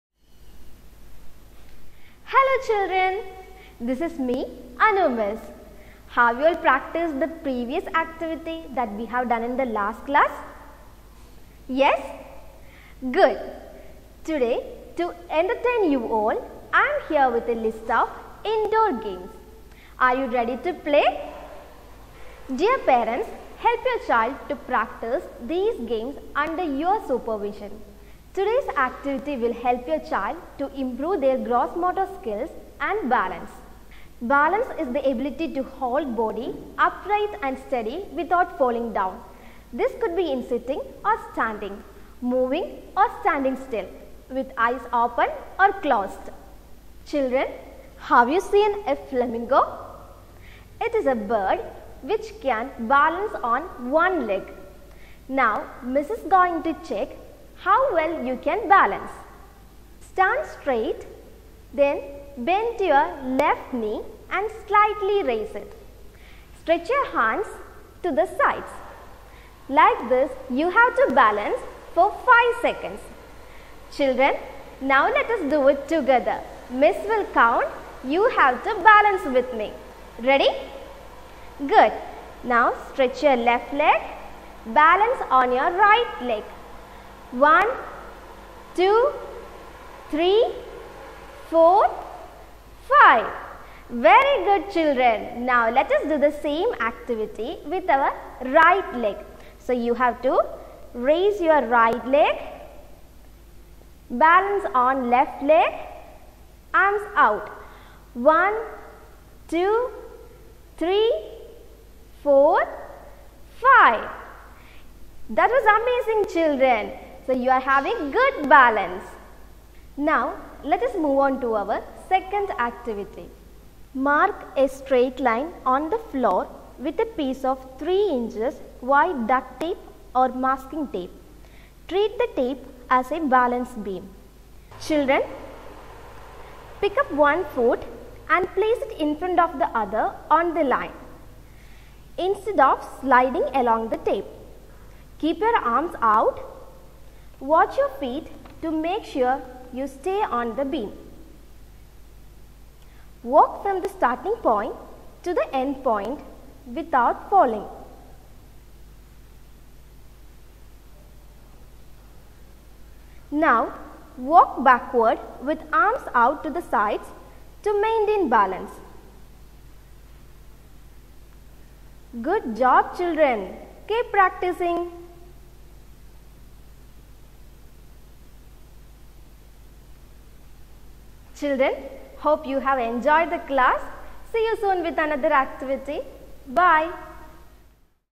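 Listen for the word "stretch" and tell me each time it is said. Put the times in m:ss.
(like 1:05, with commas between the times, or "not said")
1:06, 1:22.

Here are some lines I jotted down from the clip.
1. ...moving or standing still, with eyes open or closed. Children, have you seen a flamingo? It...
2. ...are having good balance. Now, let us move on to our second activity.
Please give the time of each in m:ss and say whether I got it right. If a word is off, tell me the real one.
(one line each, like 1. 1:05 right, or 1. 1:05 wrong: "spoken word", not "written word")
1. 0:42 right
2. 1:57 right.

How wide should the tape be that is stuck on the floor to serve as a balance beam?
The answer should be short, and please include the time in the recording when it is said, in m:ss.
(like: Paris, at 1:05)
3 inches, at 2:07.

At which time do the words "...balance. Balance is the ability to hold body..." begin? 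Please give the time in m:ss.
0:33.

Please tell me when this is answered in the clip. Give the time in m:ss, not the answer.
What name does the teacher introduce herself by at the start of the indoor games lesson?
0:04.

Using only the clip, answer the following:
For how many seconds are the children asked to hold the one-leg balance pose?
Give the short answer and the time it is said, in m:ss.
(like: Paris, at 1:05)
5 seconds, at 1:12.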